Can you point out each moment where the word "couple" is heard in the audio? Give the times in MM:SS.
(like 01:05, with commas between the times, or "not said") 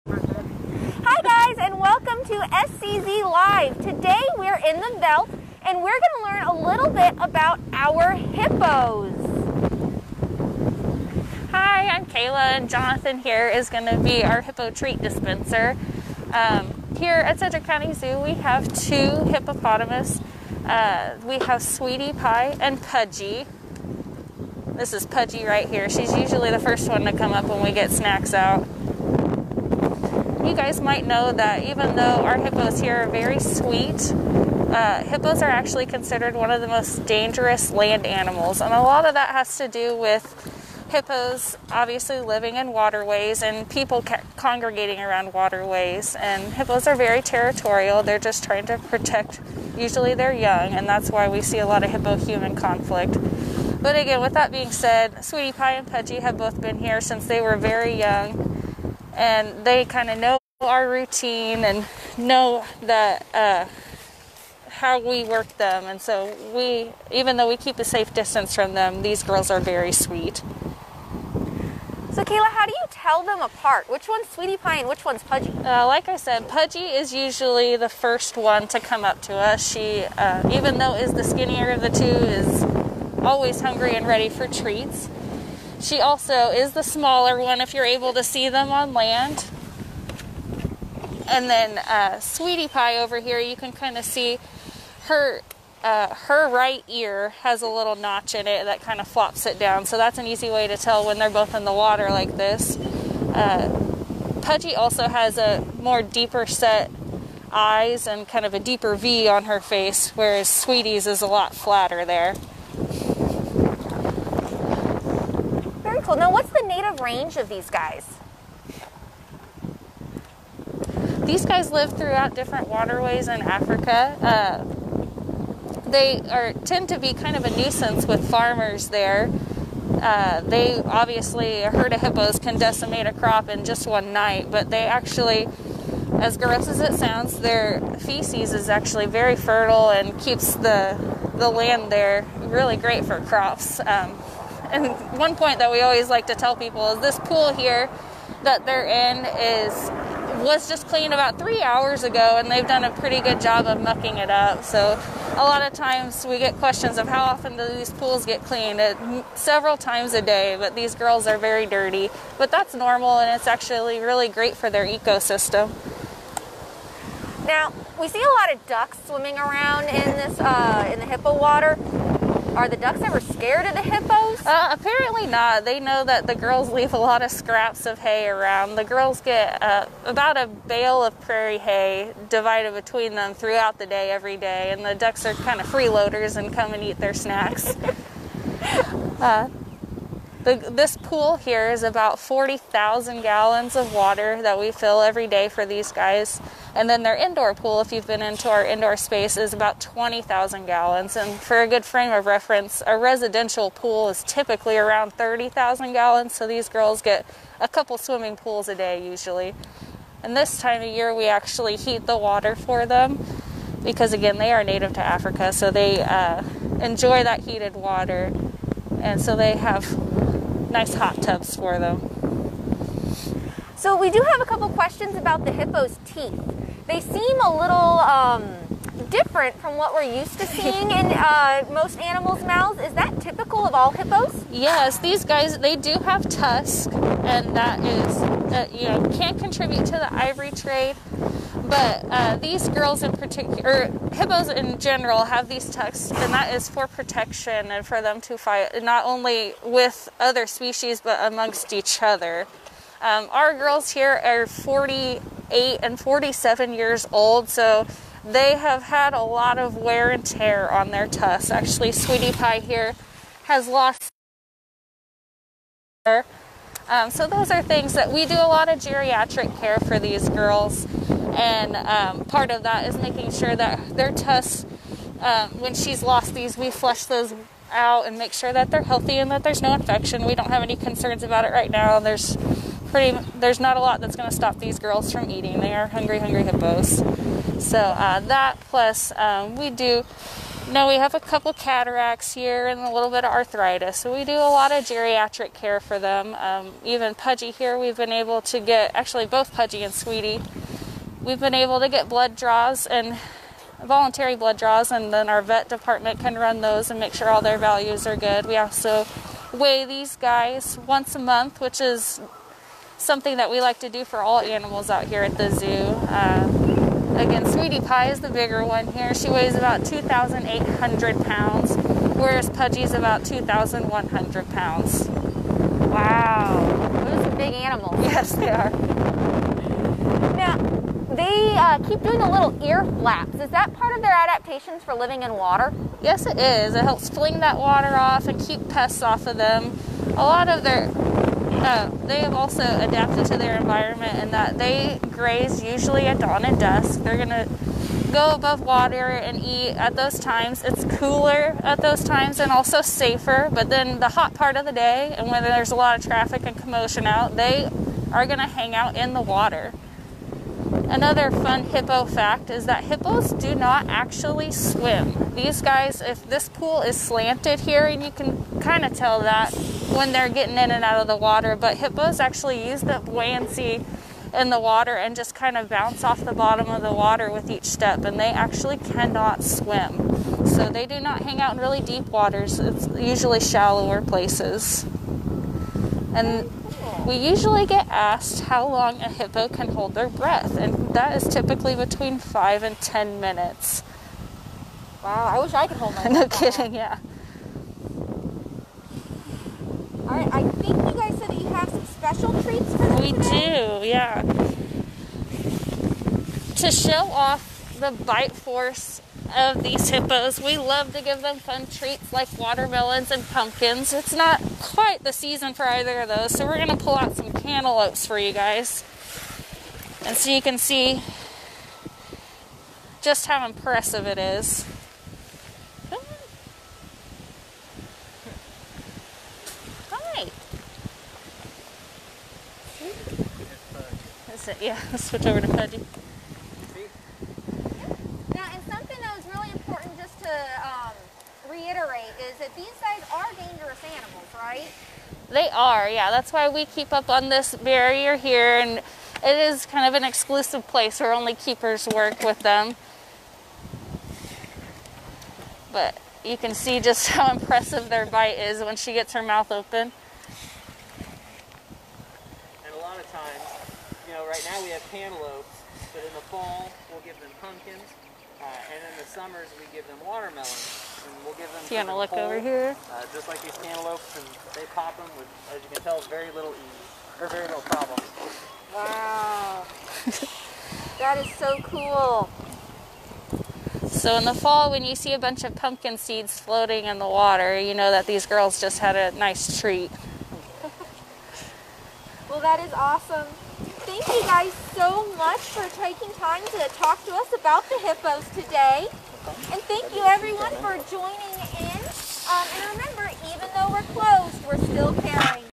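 03:27, 03:44, 04:51.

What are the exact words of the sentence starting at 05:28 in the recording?
Yes, they are they uh, keep doing the little ear flaps.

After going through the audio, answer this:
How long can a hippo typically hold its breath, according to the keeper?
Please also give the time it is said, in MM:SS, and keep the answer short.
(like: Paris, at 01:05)
5 to 10 minutes, at 06:31.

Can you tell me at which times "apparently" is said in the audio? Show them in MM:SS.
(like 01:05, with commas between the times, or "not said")
02:54.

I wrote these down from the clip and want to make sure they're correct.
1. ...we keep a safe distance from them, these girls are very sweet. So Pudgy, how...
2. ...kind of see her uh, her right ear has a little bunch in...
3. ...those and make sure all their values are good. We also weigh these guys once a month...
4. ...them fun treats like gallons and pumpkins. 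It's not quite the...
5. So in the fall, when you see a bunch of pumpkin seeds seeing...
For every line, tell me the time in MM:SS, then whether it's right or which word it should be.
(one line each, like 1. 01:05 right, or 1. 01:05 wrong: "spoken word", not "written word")
1. 01:07 wrong: "Kayla", not "Pudgy"
2. 01:33 wrong: "notch", not "bunch"
3. 05:06 right
4. 06:51 wrong: "watermelons", not "gallons"
5. 08:03 wrong: "floating", not "seeing".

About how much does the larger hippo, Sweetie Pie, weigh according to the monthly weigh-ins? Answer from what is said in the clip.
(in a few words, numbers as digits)
2,800 pounds.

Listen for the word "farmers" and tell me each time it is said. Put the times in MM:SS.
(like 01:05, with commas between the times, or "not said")
02:08.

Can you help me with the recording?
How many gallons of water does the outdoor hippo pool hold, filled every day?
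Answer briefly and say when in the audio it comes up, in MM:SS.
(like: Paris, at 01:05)
40,000 gallons, at 03:12.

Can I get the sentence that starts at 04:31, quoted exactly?
And um, part of that is making sure that their tusks.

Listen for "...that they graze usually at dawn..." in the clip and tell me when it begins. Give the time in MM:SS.
05:44.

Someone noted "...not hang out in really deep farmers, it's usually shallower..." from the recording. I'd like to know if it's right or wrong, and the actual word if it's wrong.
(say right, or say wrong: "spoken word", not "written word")
wrong: "waters", not "farmers".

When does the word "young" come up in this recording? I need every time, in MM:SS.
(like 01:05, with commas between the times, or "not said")
00:50, 00:57.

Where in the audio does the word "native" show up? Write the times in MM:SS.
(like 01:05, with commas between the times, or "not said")
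01:56, 03:34.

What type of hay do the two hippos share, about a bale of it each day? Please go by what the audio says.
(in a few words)
Prairie hay.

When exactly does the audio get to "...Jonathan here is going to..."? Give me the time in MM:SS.
00:12.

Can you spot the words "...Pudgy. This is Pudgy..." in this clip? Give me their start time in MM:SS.
00:22.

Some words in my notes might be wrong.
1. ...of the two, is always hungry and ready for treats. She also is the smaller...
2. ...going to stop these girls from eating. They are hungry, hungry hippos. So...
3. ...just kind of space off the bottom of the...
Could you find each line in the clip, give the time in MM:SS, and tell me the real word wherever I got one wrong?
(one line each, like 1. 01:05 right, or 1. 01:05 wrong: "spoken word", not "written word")
1. 01:21 right
2. 04:44 right
3. 06:15 wrong: "bounce", not "space".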